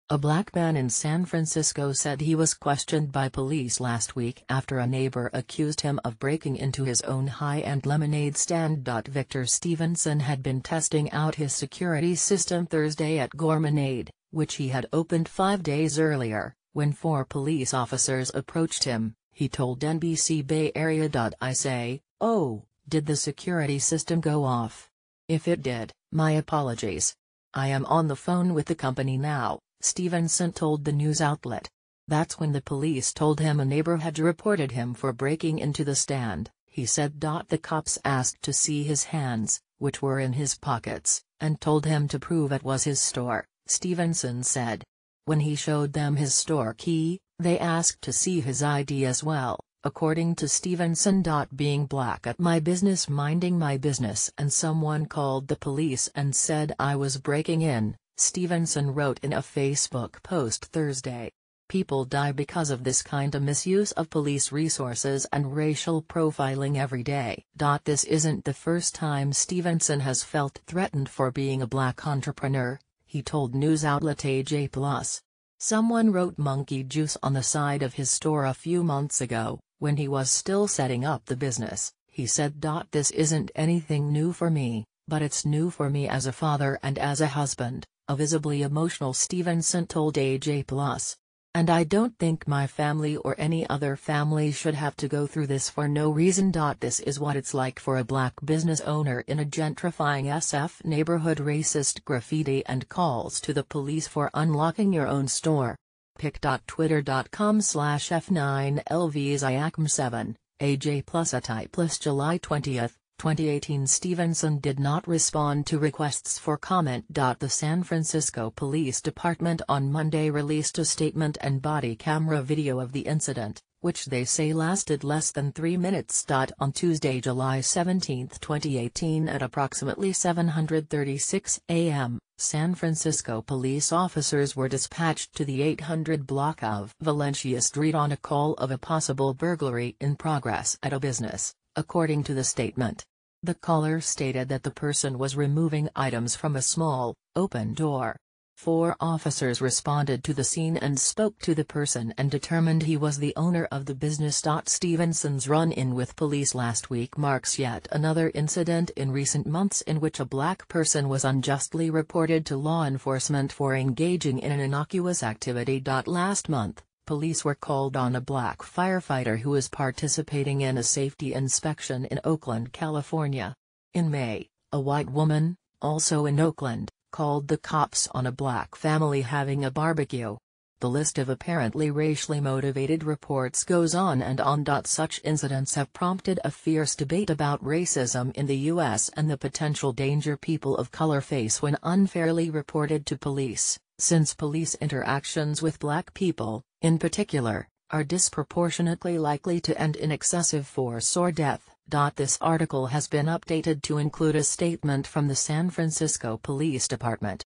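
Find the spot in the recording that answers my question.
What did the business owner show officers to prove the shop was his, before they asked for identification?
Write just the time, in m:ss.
0:46.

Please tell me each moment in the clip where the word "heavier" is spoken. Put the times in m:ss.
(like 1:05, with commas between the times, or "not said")
not said.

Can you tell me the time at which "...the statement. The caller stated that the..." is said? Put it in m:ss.
2:22.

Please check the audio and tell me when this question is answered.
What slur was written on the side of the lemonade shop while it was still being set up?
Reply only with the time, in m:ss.
1:16.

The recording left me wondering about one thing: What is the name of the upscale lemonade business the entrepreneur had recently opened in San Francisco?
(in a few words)
Gourmonade.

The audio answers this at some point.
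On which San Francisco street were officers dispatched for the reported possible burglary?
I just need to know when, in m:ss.
2:16.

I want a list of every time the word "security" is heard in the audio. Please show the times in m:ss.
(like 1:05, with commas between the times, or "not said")
0:11, 0:23.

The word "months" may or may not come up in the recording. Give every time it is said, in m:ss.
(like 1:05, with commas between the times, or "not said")
1:18, 2:39, 2:46.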